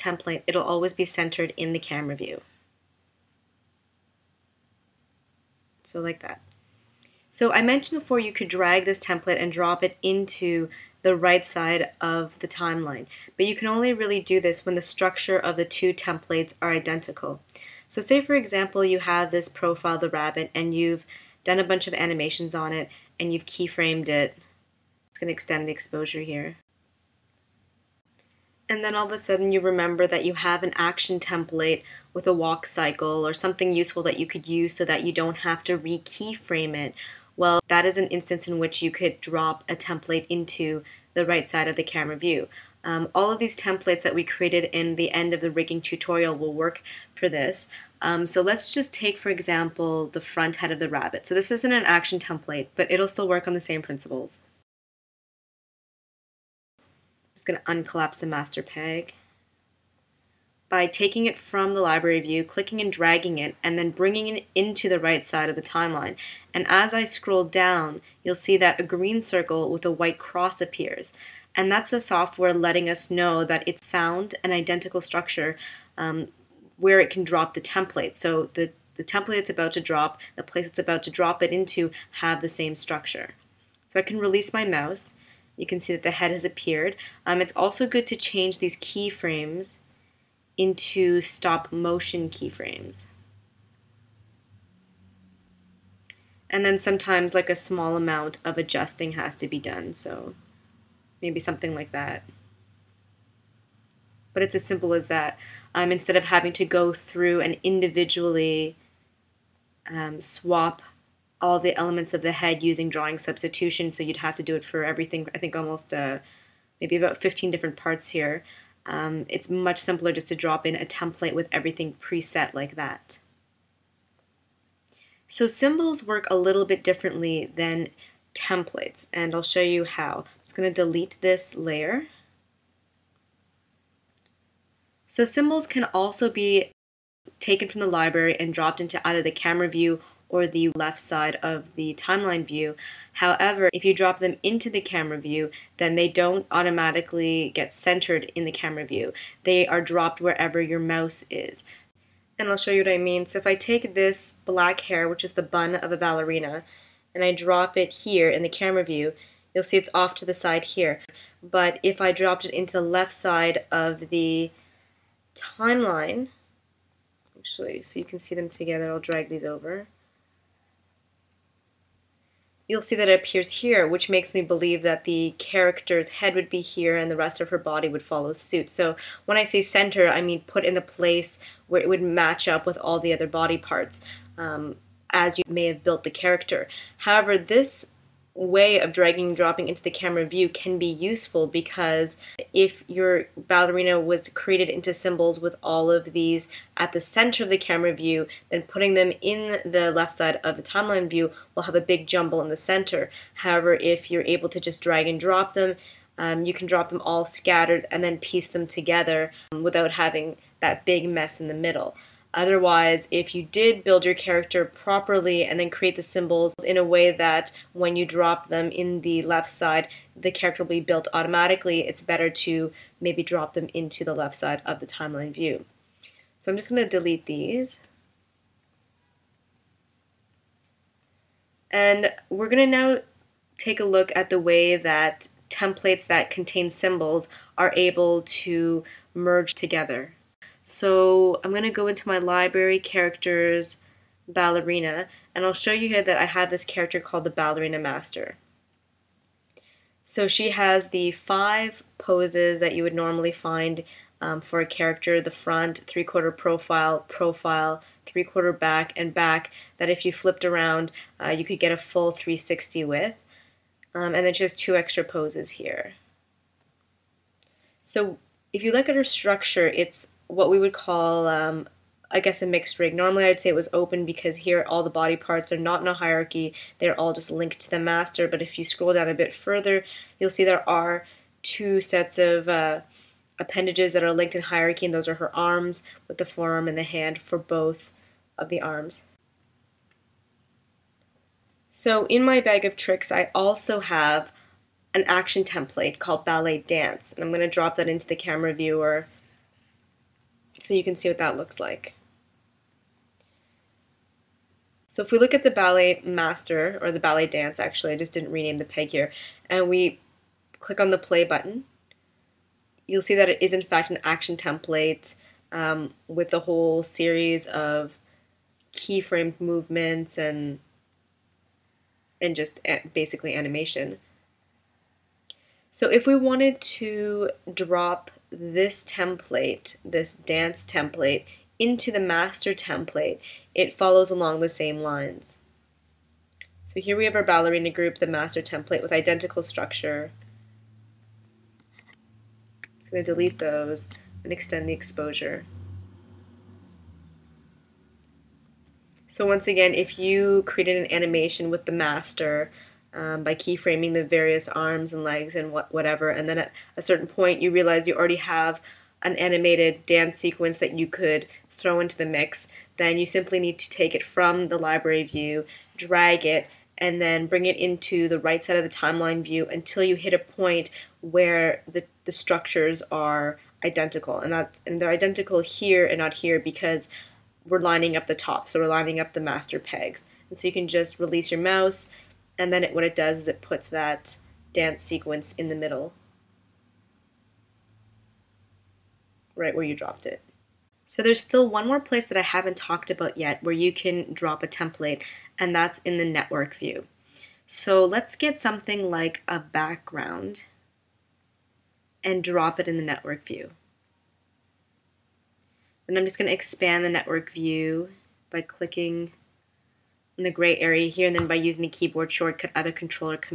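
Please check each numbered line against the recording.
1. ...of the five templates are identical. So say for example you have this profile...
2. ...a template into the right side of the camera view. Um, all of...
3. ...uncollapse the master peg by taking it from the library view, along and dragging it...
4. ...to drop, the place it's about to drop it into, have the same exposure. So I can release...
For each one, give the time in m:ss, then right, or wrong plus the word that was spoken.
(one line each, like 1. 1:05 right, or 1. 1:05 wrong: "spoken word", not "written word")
1. 0:15 wrong: "two", not "five"
2. 0:39 right
3. 0:57 wrong: "clicking", not "along"
4. 1:19 wrong: "structure", not "exposure".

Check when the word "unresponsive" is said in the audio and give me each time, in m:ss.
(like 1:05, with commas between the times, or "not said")
not said.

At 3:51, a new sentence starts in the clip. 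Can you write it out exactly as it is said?
And we're going to now take a look at the way that templates that contain symbols are able to merge together.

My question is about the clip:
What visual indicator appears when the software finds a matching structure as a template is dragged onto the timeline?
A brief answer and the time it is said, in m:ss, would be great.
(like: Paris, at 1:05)
Green circle with a white cross, at 1:08.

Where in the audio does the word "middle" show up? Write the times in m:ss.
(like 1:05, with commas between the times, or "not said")
3:31, 6:25.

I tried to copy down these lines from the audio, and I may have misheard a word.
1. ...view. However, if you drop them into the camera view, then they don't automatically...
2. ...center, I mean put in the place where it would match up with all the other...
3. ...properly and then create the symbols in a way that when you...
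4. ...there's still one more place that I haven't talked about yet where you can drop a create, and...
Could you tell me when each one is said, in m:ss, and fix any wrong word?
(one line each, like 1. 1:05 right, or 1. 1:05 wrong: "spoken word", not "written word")
1. 2:22 right
2. 2:59 right
3. 3:34 right
4. 6:31 wrong: "template", not "create".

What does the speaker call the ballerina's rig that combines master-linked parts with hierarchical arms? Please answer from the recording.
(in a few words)
Mixed rig.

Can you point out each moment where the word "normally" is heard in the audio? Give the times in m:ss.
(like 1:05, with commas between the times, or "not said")
4:12, 4:32.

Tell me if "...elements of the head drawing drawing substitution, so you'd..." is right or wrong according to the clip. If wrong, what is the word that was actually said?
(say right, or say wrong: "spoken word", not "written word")
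wrong: "using", not "drawing".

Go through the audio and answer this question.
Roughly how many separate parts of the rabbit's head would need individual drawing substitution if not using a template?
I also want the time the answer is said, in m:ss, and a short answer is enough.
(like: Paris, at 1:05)
15, at 1:57.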